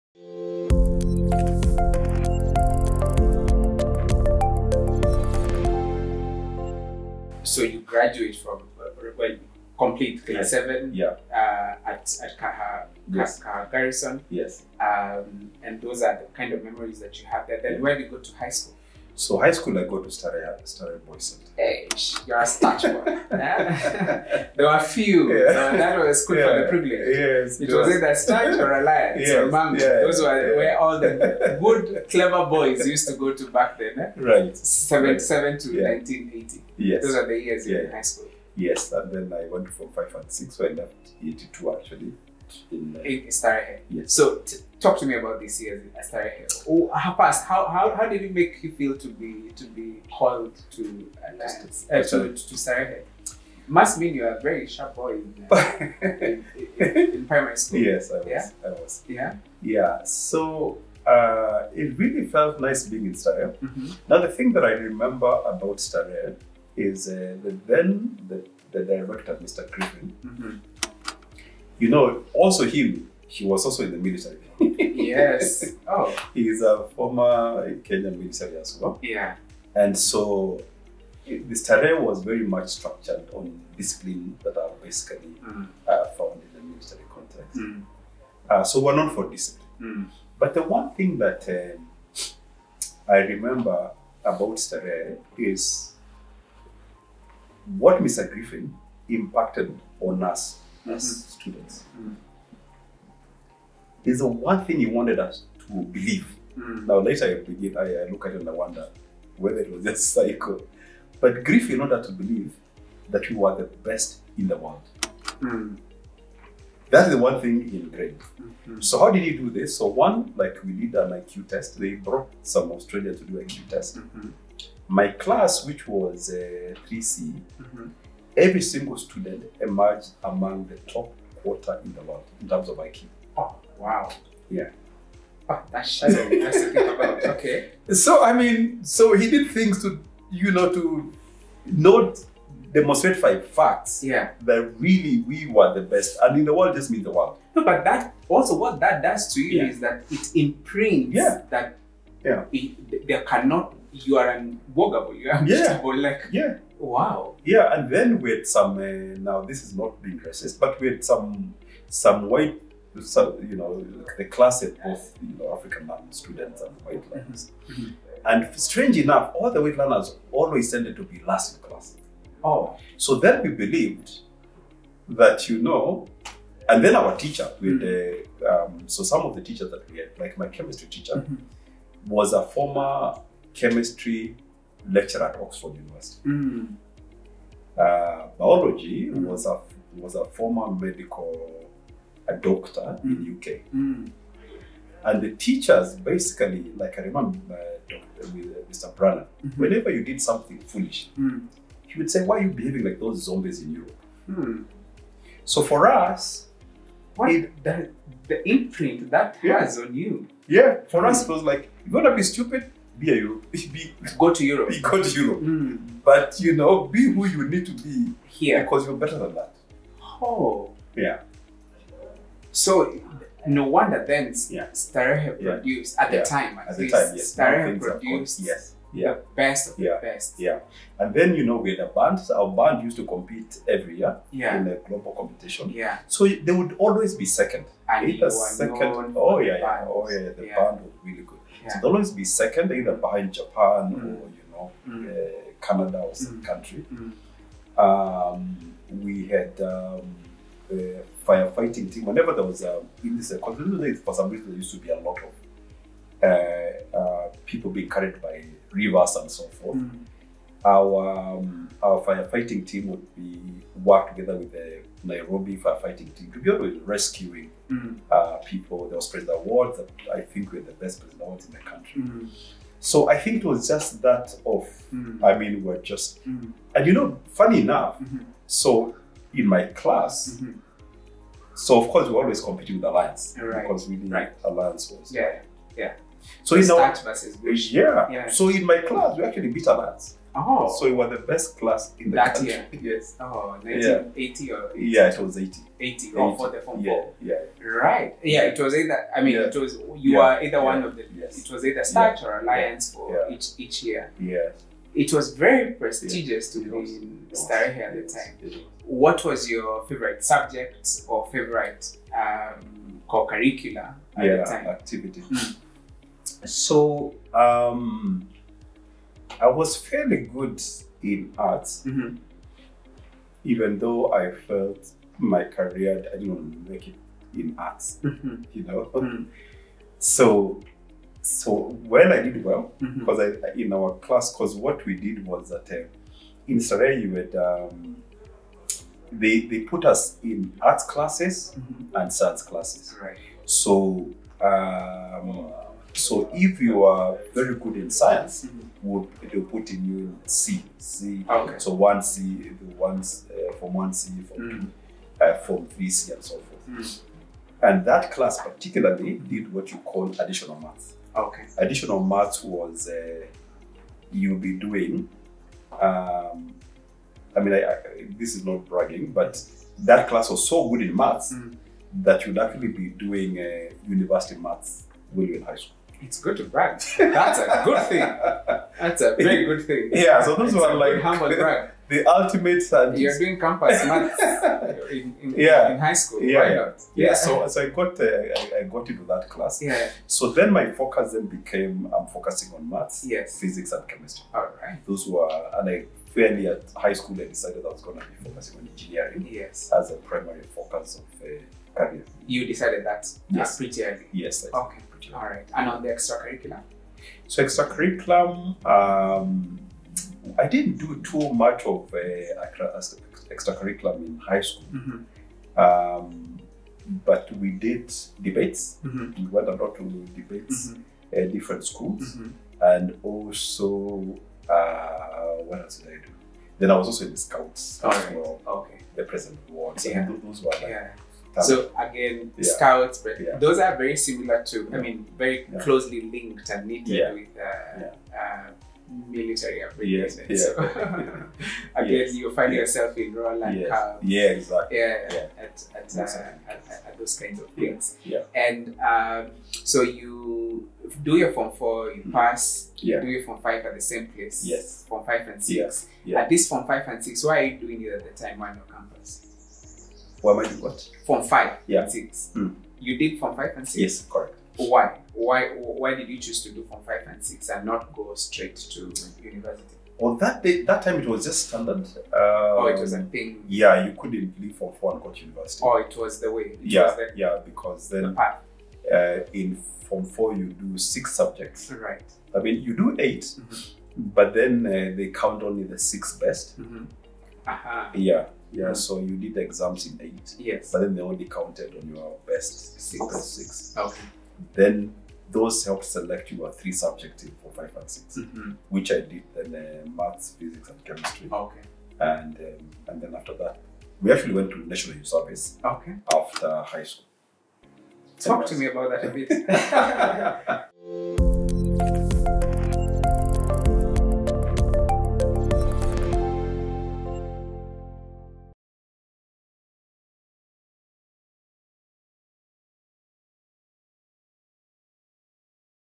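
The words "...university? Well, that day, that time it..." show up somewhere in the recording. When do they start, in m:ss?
7:49.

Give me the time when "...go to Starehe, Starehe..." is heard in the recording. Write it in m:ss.
0:19.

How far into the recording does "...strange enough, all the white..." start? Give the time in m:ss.
2:48.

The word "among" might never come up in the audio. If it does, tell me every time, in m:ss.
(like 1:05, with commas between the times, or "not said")
2:10.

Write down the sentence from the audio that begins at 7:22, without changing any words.
you find yourself in rural land.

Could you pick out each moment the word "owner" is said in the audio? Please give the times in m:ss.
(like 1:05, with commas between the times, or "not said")
not said.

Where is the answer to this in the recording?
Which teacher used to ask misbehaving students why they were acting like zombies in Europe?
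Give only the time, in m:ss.
3:18.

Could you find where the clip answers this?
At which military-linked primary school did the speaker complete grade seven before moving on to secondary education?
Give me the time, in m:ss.
0:13.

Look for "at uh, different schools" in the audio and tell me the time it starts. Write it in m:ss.
7:01.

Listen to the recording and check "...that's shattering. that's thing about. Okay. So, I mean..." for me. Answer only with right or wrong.
right.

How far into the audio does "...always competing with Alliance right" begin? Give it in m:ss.
4:42.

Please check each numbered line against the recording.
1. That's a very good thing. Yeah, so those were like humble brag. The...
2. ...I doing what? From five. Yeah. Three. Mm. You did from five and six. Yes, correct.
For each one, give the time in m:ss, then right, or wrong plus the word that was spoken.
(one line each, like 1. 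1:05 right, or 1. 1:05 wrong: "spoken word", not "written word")
1. 6:18 right
2. 7:40 wrong: "Six", not "Three".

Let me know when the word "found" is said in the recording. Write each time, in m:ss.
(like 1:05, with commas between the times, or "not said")
1:26.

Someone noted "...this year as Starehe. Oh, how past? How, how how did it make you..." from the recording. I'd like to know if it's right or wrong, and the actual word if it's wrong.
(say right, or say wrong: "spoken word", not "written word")
right.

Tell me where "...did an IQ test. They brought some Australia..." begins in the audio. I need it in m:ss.
2:00.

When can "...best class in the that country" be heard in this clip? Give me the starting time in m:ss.
4:51.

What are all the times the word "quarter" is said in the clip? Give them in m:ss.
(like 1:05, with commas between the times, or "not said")
2:11.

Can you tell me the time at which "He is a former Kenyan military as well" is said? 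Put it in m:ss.
1:16.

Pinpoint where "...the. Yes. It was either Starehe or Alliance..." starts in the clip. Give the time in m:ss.
5:00.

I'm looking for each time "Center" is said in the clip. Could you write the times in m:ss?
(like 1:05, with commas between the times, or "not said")
0:21.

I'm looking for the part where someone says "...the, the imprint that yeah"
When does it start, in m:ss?
3:27.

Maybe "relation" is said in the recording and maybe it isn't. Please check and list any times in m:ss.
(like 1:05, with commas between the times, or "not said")
not said.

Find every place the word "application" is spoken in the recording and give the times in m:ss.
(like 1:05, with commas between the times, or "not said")
7:19.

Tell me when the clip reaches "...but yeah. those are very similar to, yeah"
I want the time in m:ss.
7:12.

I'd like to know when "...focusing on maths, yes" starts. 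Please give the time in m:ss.
6:32.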